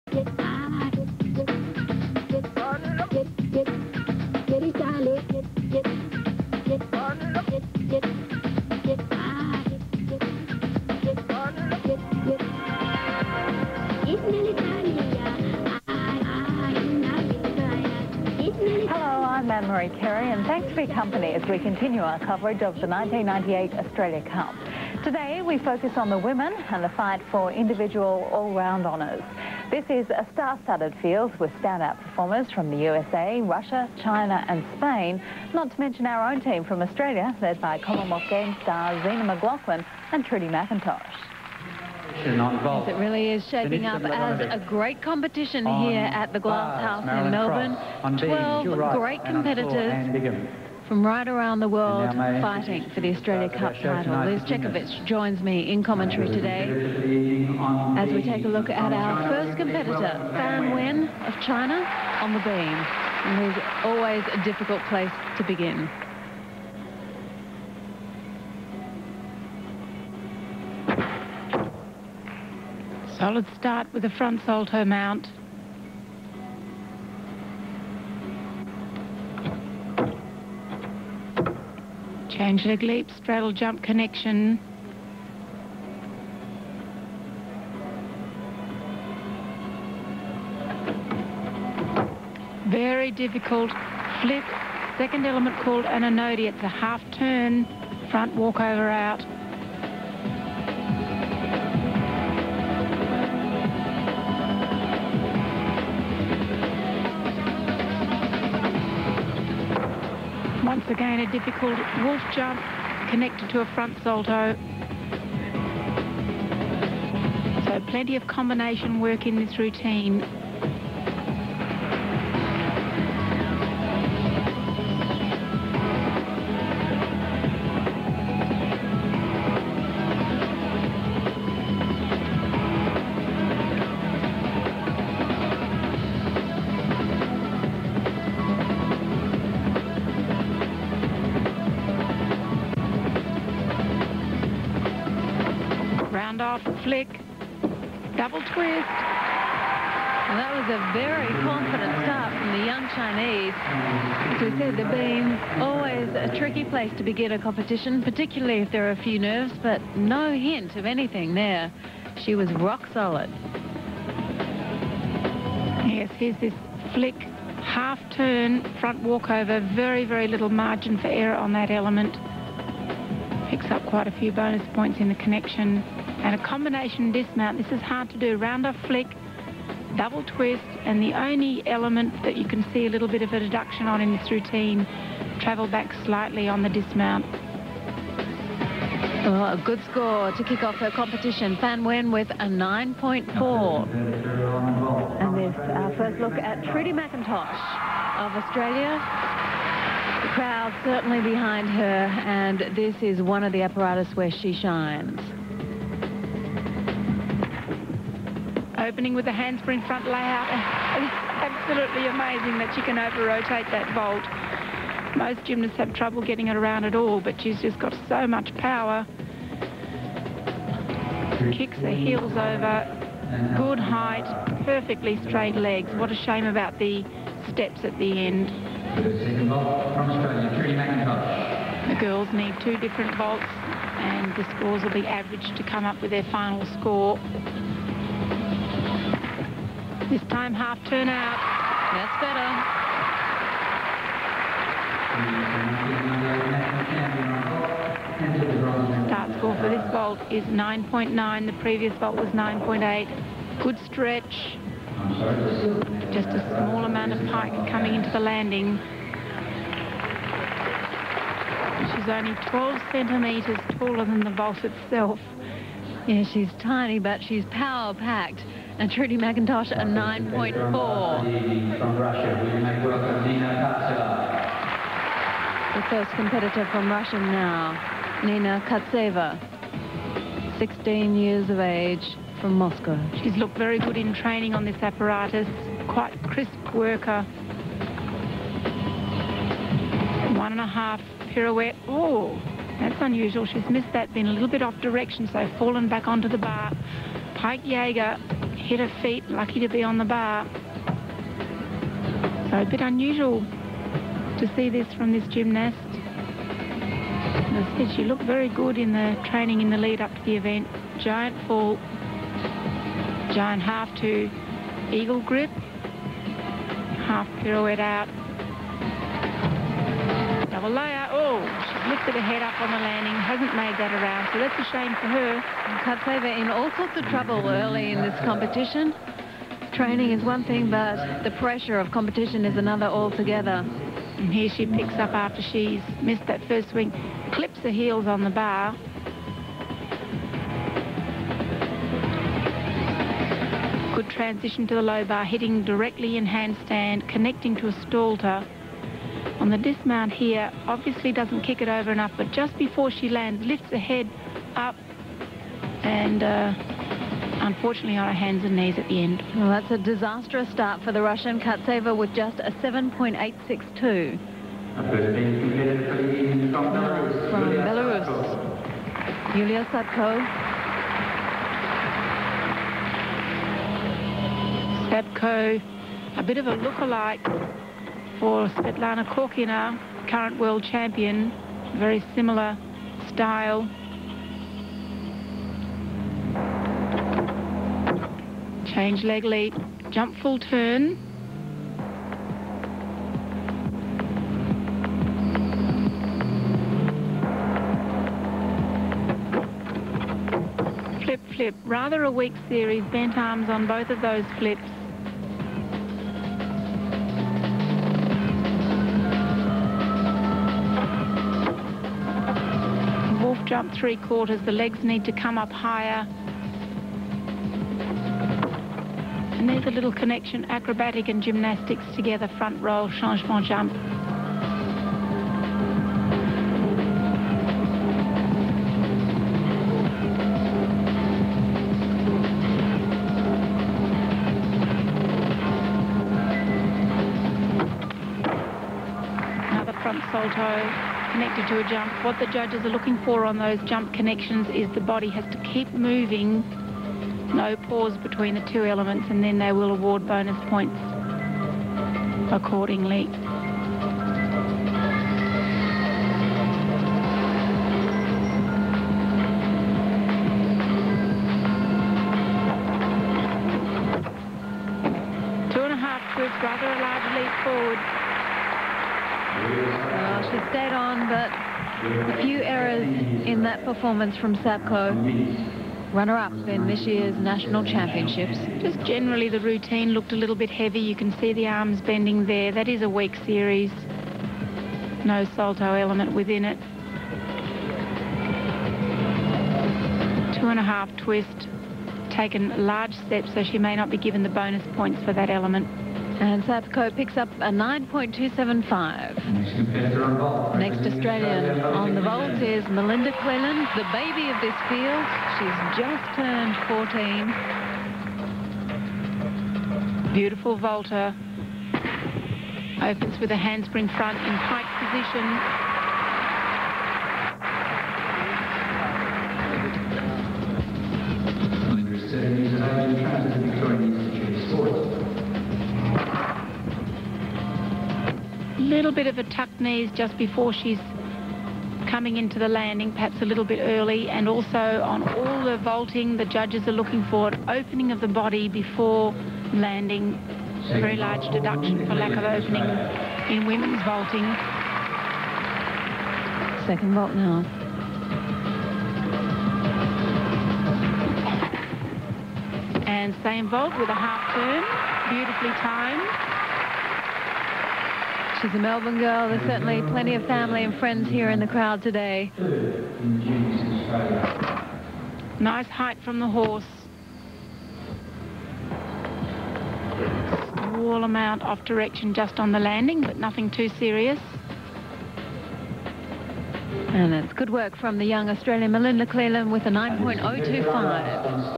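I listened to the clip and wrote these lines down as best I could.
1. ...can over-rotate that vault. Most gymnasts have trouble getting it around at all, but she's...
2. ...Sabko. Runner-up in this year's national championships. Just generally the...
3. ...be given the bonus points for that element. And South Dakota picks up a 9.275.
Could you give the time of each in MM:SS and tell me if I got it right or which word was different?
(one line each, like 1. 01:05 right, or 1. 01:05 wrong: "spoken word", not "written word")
1. 03:32 right
2. 07:54 right
3. 08:13 right.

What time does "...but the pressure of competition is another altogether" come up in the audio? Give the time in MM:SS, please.
05:30.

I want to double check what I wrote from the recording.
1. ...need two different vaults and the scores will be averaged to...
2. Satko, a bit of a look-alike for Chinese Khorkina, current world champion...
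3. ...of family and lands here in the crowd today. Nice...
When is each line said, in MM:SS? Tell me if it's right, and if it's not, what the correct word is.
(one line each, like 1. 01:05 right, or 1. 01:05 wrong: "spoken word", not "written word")
1. 03:52 right
2. 06:14 wrong: "Svetlana", not "Chinese"
3. 09:20 wrong: "friends", not "lands".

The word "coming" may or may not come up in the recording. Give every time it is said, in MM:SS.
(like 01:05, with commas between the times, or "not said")
04:17, 08:51.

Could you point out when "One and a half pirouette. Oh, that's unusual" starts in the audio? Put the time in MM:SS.
04:50.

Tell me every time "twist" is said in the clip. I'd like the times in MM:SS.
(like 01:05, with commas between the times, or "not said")
02:28, 03:00, 08:10.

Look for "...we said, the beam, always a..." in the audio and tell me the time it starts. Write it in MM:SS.
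02:34.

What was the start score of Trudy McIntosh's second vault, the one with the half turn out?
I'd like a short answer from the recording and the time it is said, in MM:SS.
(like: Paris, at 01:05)
9.9, at 04:10.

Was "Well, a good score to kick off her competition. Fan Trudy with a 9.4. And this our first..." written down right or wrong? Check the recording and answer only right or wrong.
wrong.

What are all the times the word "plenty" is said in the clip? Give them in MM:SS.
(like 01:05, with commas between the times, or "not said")
01:57, 09:19.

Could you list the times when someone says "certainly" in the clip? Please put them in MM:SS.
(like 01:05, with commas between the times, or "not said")
03:20, 09:19.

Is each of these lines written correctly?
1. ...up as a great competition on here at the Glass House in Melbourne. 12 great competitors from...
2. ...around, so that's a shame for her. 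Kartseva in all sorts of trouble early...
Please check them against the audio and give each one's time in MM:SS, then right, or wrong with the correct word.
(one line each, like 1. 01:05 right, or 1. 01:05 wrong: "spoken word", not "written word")
1. 00:43 right
2. 05:23 right.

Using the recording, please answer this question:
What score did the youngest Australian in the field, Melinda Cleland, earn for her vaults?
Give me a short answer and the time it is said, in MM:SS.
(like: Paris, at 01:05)
9.025, at 09:39.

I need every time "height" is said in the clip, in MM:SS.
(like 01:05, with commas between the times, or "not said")
03:43, 09:25.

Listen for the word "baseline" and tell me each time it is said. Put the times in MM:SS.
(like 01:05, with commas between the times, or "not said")
not said.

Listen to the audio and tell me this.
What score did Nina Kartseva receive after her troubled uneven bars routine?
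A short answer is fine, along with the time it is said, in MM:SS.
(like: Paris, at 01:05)
7.862, at 06:02.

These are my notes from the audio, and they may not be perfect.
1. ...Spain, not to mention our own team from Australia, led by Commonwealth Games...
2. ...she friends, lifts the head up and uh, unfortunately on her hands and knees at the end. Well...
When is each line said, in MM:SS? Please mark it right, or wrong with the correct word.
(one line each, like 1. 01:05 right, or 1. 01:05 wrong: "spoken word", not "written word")
1. 00:34 right
2. 05:52 wrong: "lands", not "friends".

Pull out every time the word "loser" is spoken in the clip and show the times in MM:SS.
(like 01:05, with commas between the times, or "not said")
not said.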